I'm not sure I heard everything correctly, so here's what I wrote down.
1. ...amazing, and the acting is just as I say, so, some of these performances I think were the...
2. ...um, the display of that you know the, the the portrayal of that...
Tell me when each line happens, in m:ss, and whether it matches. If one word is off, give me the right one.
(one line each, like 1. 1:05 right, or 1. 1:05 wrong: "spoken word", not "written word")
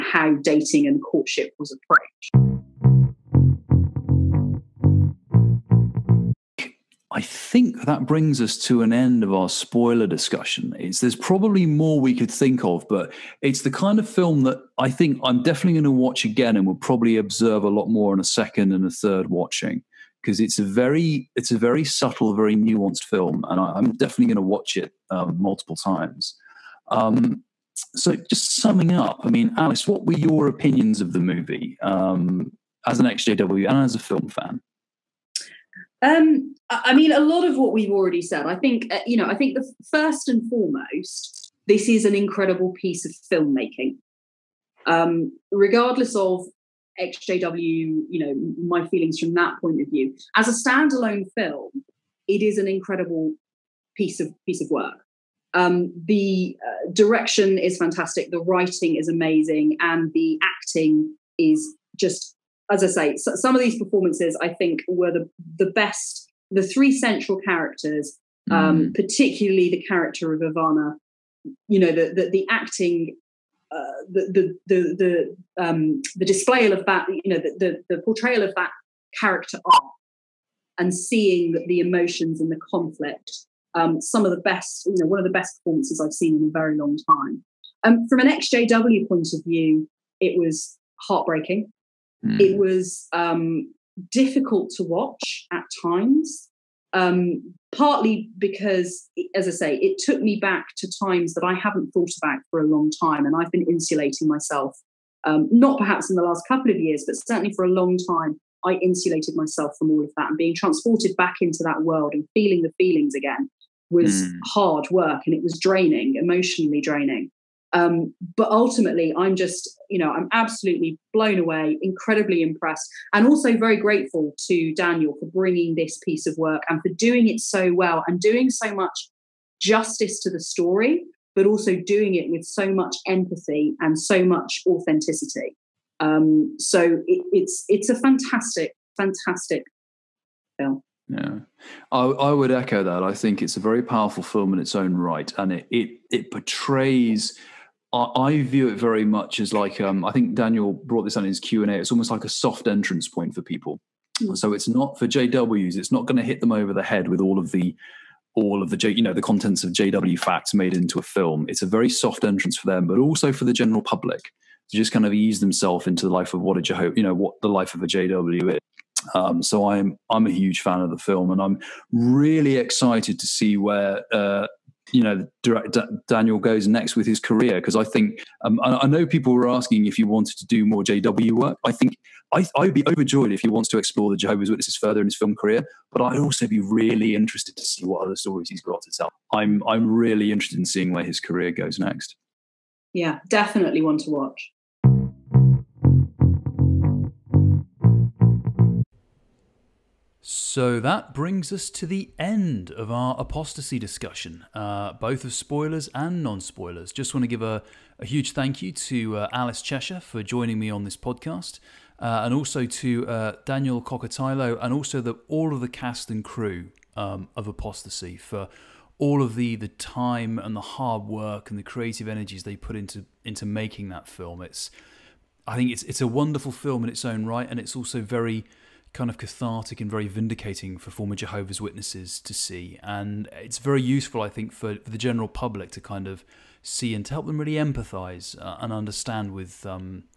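1. 0:59 right
2. 1:15 right.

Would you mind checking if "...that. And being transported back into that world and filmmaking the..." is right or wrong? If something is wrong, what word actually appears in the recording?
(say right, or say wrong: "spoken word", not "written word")
wrong: "feeling", not "filmmaking".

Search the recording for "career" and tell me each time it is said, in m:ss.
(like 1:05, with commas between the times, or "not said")
2:57, 3:05, 3:11.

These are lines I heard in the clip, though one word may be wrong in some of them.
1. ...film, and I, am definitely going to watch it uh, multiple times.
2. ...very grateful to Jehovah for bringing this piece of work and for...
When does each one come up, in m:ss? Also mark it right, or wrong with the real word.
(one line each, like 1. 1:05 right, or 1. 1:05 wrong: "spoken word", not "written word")
1. 0:23 right
2. 2:03 wrong: "Daniel", not "Jehovah".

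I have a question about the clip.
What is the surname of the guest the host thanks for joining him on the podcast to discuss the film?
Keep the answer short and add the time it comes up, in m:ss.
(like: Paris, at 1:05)
Cheshire, at 3:29.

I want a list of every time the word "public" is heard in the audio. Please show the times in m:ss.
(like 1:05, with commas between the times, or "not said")
2:43, 3:55.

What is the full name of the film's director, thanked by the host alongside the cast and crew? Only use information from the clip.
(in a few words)
Daniel Kokotajlo.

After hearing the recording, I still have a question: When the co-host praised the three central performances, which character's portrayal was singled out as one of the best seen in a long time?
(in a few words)
Ivanna.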